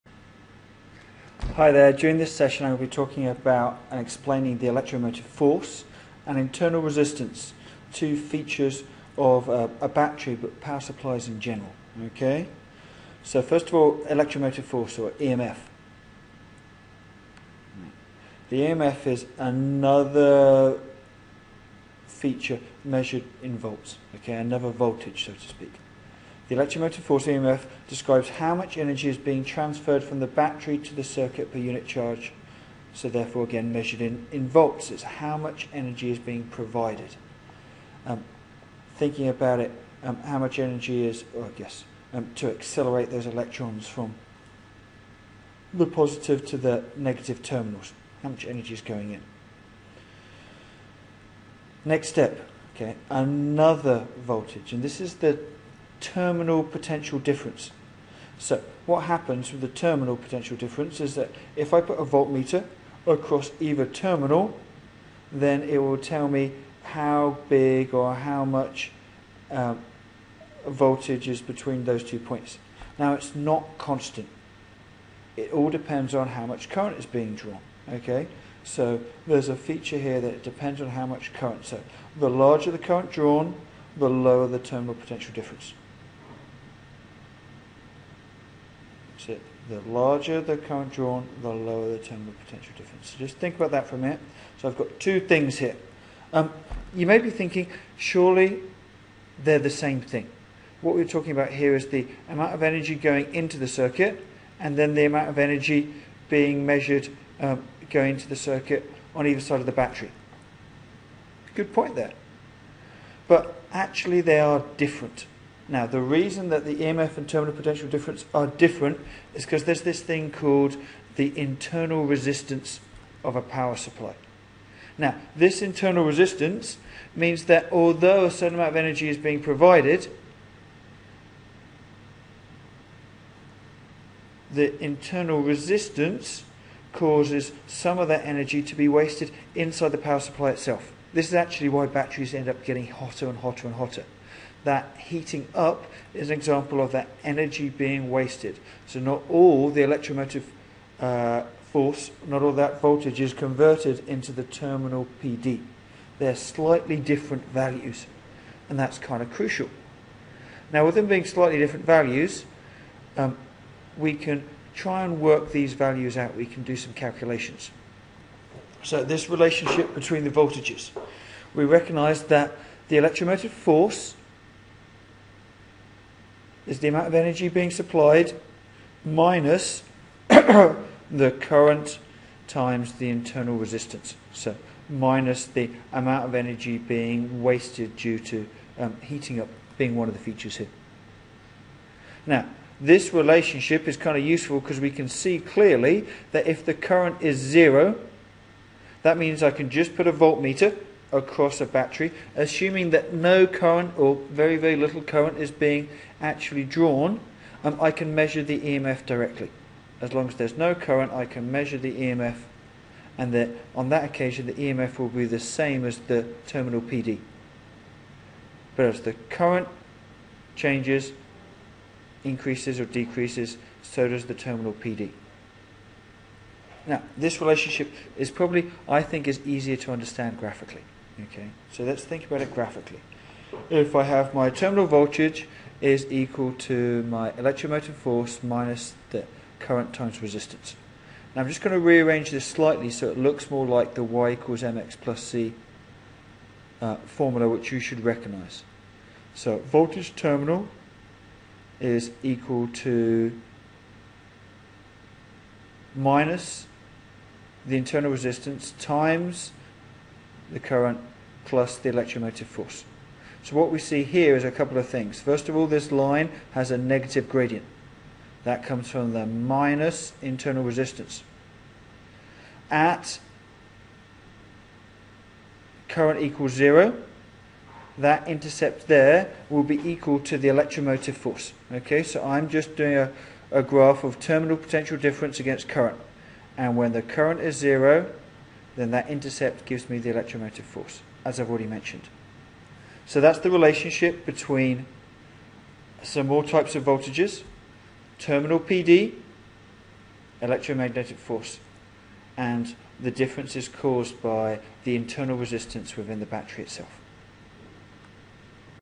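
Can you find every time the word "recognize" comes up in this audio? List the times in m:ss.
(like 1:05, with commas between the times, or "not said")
2:51, 4:08.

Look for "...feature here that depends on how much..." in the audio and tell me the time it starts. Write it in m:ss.
1:19.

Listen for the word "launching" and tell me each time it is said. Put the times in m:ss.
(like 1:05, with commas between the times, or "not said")
not said.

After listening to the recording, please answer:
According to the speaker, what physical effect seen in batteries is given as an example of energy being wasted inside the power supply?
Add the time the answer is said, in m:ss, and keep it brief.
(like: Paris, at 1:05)
Getting hotter, at 2:22.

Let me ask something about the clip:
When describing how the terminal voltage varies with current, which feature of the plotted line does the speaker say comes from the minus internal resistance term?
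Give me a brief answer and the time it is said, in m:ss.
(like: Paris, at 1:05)
Negative gradient, at 4:26.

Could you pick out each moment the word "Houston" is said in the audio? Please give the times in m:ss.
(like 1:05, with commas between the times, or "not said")
not said.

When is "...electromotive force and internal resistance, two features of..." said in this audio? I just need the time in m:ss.
0:04.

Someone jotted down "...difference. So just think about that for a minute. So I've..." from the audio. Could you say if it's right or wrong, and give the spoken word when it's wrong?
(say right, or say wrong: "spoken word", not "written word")
right.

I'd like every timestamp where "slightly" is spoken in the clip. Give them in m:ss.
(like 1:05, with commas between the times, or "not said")
2:36, 2:41, 4:02.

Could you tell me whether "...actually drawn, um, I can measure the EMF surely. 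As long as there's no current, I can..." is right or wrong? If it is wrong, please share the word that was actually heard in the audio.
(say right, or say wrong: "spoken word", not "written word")
wrong: "directly", not "surely".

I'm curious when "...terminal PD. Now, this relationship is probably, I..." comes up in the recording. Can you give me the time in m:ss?
3:44.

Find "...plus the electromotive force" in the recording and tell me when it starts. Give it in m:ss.
4:21.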